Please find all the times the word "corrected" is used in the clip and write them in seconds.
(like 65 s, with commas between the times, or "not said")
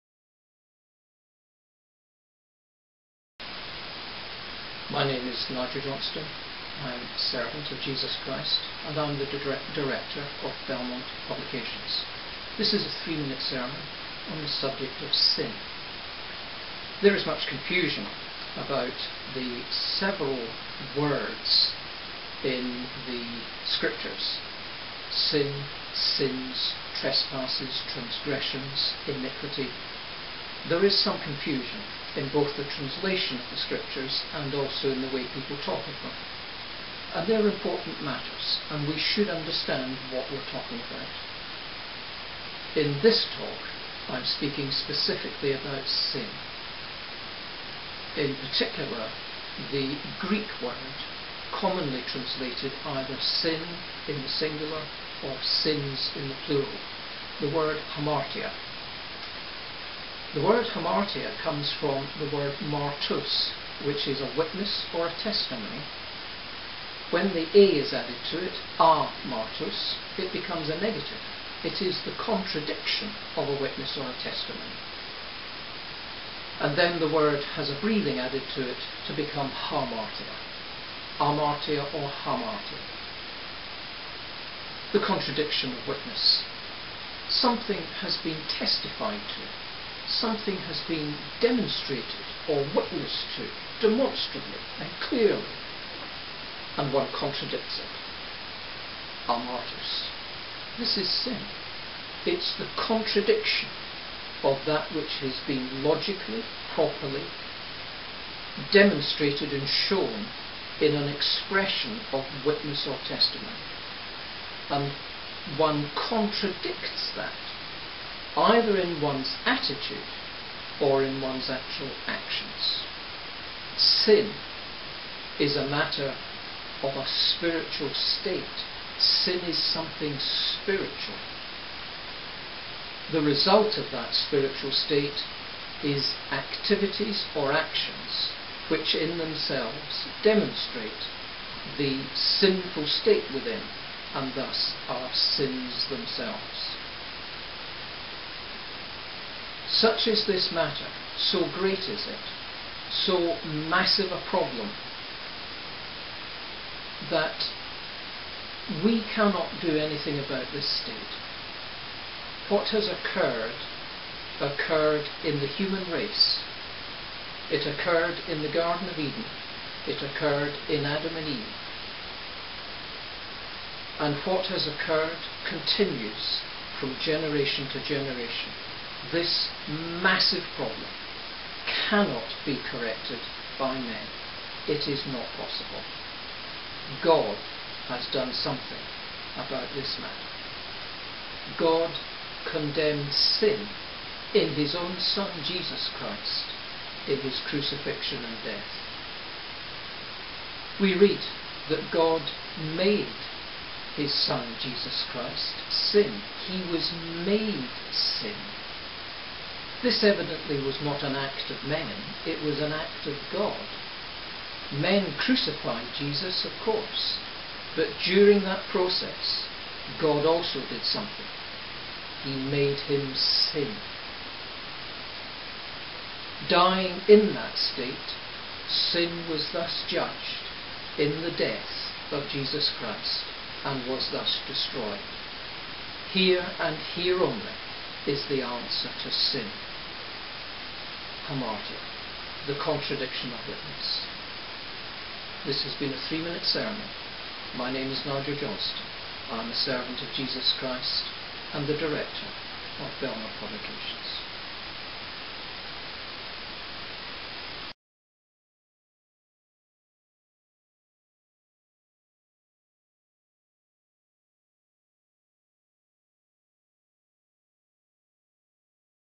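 182 s.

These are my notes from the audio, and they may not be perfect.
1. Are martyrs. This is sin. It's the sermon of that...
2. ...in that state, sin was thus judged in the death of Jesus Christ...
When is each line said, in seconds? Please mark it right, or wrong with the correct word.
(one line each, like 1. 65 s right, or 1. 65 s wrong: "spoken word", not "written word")
1. 99 s wrong: "contradiction", not "sermon"
2. 227 s right.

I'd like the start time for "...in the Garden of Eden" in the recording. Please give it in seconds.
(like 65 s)
168 s.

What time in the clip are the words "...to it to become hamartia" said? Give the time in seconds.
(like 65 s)
78 s.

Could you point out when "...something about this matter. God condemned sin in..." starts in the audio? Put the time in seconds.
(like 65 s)
188 s.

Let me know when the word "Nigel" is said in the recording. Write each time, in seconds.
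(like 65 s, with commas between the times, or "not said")
5 s, 248 s.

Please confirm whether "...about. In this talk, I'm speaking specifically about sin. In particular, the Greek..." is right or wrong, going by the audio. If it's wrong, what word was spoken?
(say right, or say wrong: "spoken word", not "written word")
right.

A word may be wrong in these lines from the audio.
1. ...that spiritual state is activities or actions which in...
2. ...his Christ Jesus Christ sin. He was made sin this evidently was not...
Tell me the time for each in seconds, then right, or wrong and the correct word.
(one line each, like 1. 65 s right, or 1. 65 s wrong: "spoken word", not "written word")
1. 133 s right
2. 203 s wrong: "Son", not "Christ".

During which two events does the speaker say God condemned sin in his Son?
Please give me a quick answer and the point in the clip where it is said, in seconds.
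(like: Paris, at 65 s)
crucifixion and death, at 197 s.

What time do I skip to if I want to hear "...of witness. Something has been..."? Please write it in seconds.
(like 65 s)
85 s.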